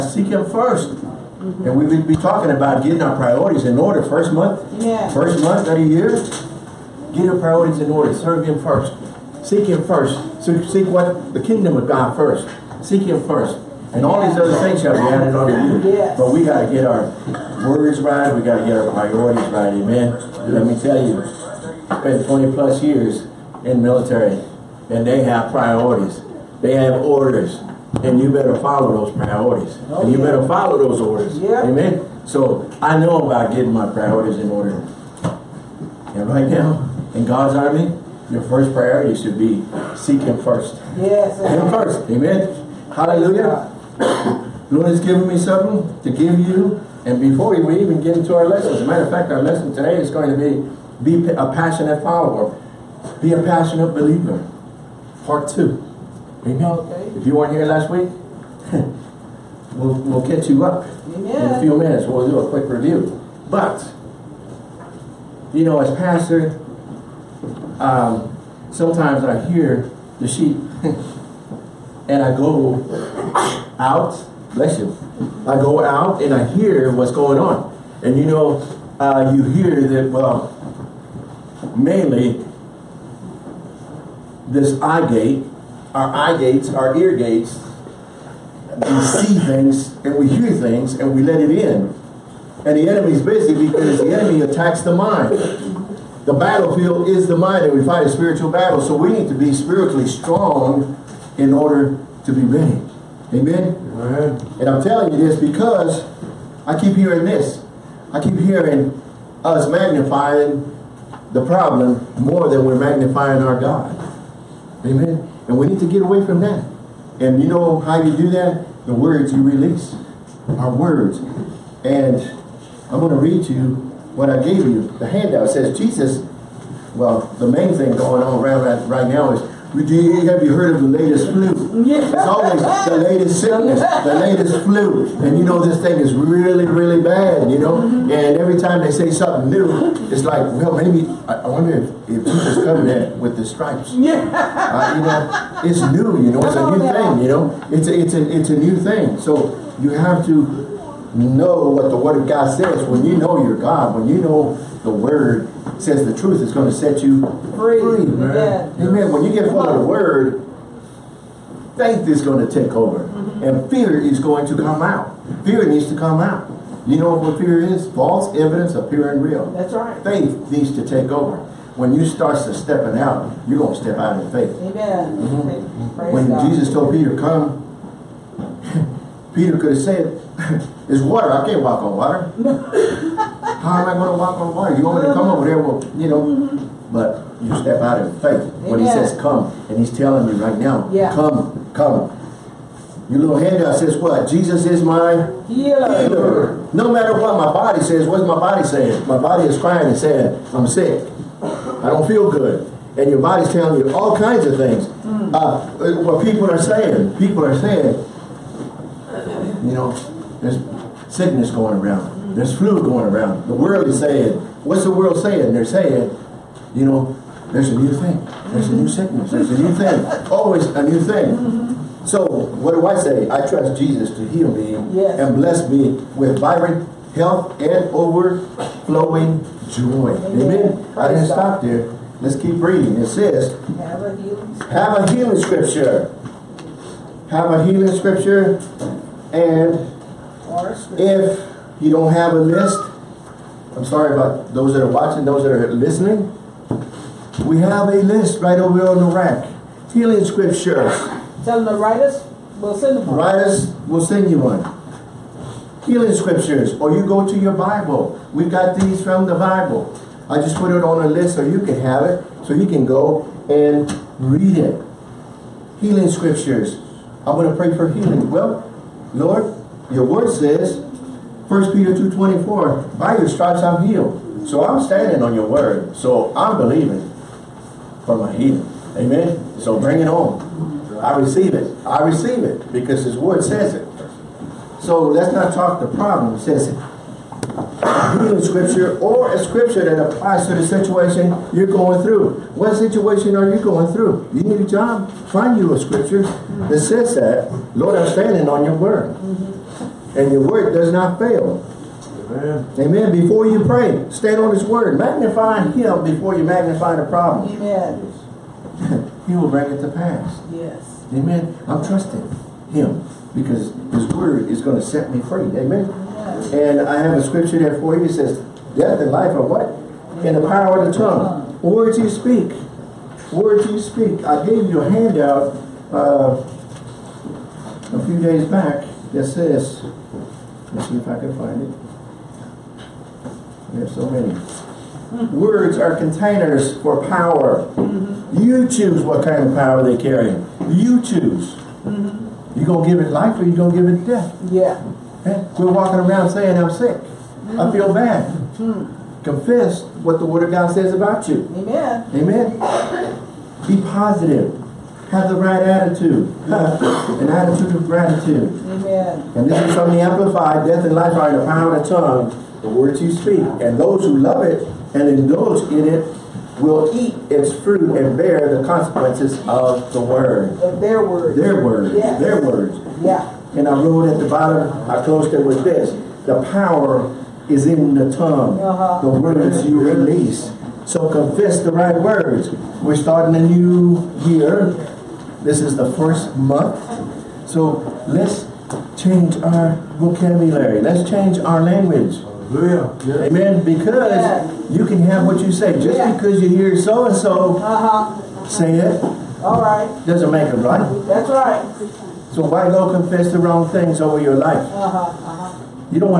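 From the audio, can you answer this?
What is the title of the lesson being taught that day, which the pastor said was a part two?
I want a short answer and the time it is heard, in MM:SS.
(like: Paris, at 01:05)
Be a passionate follower, at 00:51.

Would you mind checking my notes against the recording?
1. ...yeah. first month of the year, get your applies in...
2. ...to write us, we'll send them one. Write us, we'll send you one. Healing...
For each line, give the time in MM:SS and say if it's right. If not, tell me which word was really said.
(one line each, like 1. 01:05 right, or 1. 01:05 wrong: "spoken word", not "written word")
1. 00:04 wrong: "priorities", not "applies"
2. 04:11 right.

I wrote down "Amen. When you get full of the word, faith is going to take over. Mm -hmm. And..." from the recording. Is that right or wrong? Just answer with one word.
right.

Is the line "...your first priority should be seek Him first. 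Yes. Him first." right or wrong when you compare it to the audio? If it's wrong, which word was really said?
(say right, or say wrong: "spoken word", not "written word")
right.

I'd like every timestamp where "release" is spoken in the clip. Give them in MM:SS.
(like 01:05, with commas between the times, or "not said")
01:59, 06:19.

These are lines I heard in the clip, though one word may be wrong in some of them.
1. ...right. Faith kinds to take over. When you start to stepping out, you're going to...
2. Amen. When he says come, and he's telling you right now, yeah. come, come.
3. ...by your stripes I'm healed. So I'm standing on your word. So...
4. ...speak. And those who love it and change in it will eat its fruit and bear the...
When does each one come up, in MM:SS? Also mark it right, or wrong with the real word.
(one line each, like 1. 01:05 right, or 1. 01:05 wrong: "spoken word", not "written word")
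1. 02:49 wrong: "needs", not "kinds"
2. 03:08 right
3. 04:32 right
4. 06:03 wrong: "indulge", not "change".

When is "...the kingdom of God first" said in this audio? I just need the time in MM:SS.
00:11.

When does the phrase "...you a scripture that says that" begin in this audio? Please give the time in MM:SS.
04:55.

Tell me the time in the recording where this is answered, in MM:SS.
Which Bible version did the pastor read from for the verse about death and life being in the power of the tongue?
05:59.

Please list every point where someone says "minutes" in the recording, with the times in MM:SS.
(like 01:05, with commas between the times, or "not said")
01:01.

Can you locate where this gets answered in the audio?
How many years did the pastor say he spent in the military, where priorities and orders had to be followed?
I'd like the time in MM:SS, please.
00:22.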